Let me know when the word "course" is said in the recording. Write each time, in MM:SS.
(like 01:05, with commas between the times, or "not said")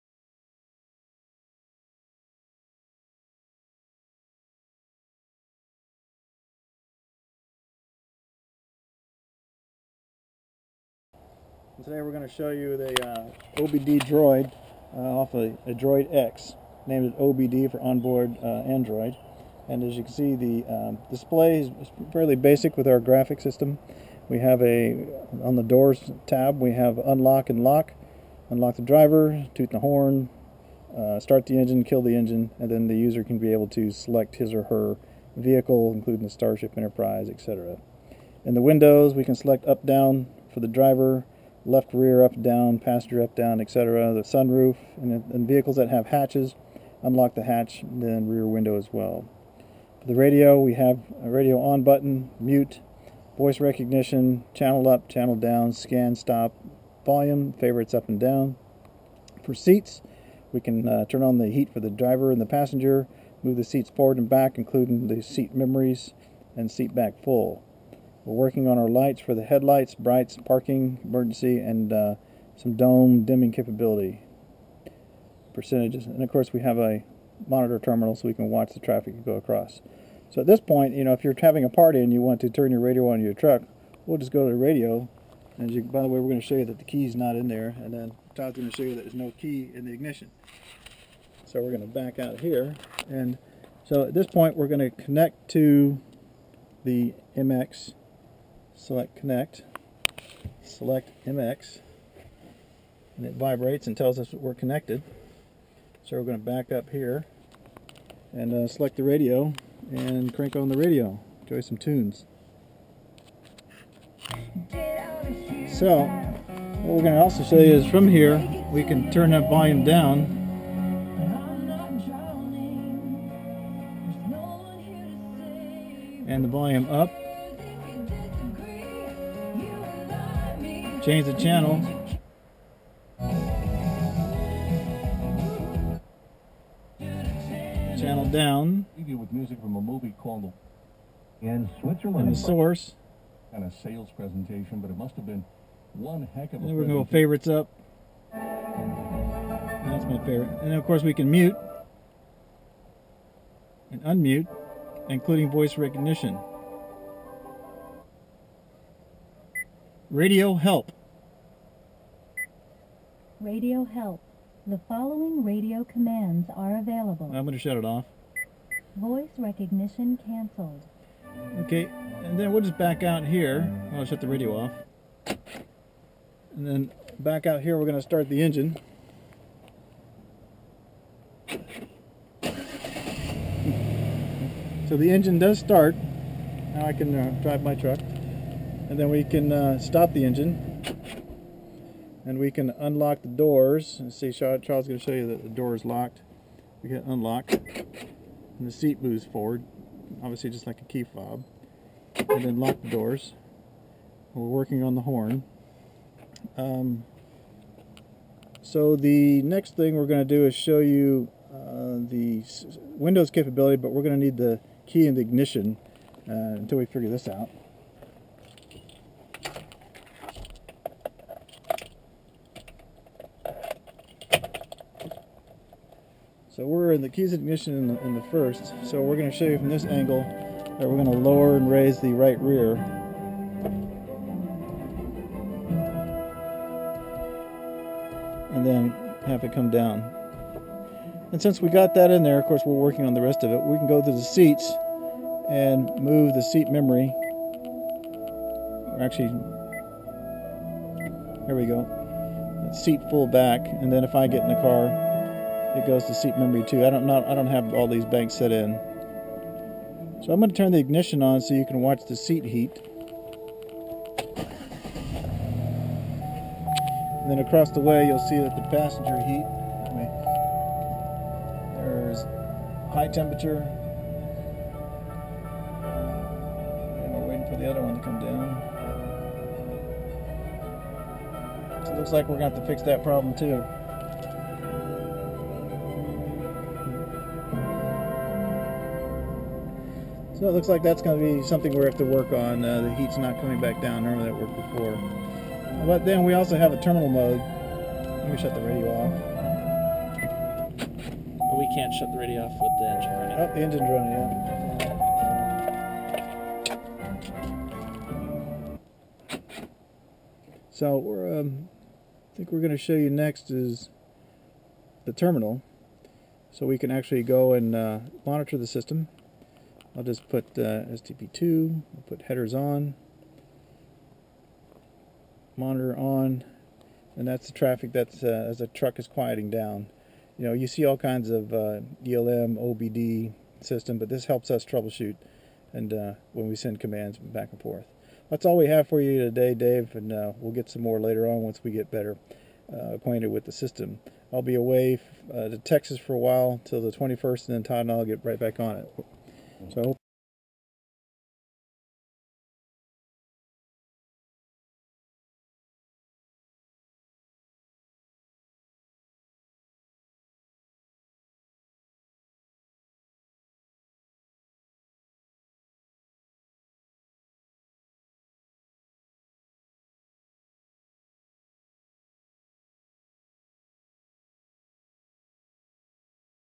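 01:16, 02:30, 04:02.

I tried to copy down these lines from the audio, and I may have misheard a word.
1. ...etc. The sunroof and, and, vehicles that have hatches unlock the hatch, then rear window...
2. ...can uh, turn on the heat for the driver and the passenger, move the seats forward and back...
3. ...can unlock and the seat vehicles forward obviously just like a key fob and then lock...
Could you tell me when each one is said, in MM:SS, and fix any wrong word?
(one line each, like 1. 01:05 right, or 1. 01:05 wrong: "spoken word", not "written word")
1. 00:43 right
2. 01:00 right
3. 03:16 wrong: "moves", not "vehicles".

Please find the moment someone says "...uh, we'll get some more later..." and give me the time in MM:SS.
05:40.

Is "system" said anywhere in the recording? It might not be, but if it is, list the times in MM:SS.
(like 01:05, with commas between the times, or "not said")
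00:23, 05:18, 05:33, 05:43.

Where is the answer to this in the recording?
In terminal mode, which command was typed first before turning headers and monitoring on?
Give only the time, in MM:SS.
05:20.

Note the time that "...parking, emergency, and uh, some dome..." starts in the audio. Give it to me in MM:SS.
01:10.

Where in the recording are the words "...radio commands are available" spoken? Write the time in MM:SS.
02:45.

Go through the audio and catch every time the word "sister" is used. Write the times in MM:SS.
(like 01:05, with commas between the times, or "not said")
not said.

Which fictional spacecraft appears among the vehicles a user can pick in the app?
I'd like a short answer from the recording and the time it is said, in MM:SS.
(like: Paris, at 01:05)
Starship Enterprise, at 00:36.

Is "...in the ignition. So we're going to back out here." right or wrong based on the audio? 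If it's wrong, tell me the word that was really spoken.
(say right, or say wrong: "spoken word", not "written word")
right.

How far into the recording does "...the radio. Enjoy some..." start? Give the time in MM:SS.
01:50.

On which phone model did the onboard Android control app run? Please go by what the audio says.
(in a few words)
Droid X.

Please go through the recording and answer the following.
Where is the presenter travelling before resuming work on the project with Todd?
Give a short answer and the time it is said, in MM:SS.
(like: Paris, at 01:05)
Texas, at 05:45.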